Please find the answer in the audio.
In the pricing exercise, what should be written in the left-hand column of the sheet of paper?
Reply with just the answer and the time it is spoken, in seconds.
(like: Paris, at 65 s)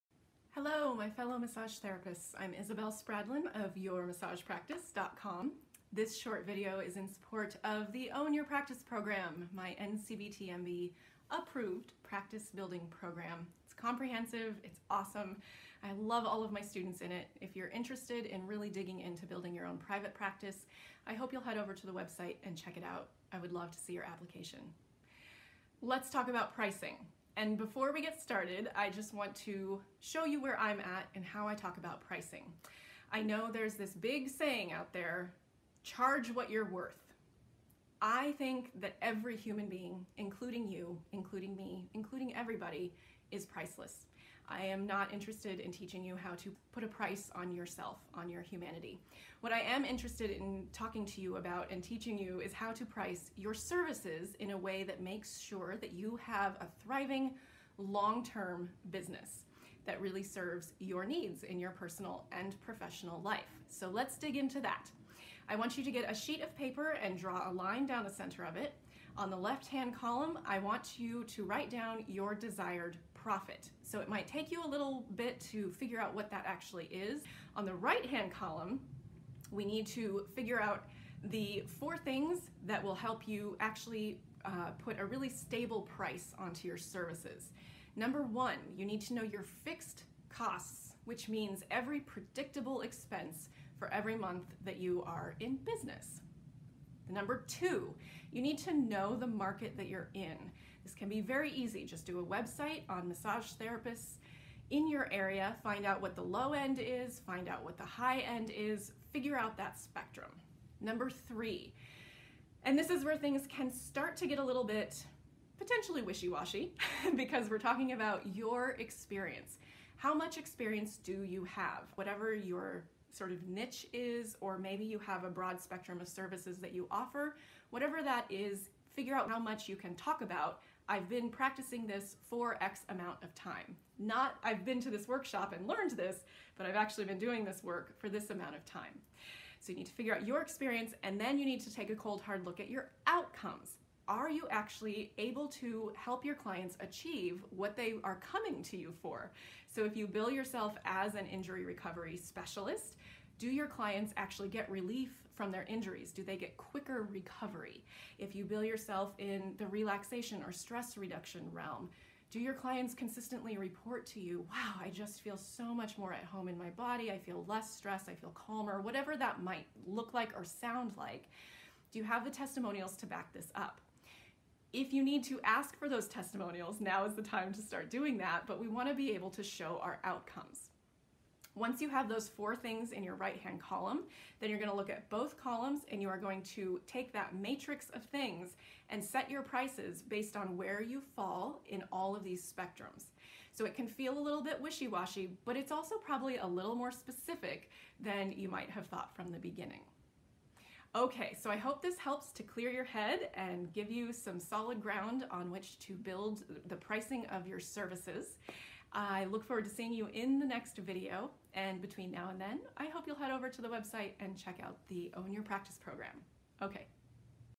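Desired profit, at 72 s.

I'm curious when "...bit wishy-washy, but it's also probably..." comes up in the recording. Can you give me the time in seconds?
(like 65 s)
194 s.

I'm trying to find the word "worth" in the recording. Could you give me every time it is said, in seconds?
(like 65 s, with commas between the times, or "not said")
36 s.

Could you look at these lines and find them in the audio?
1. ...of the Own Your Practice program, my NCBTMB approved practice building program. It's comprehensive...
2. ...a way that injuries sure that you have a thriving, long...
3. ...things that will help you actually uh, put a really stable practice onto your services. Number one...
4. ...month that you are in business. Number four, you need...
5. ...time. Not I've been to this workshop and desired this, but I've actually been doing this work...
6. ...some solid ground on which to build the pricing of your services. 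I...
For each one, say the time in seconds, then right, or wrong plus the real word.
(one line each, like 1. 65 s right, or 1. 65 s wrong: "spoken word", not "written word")
1. 7 s right
2. 54 s wrong: "makes", not "injuries"
3. 81 s wrong: "price", not "practice"
4. 94 s wrong: "two", not "four"
5. 133 s wrong: "learned", not "desired"
6. 204 s right.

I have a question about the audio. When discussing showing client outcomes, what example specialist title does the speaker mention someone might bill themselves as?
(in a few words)
Injury recovery specialist.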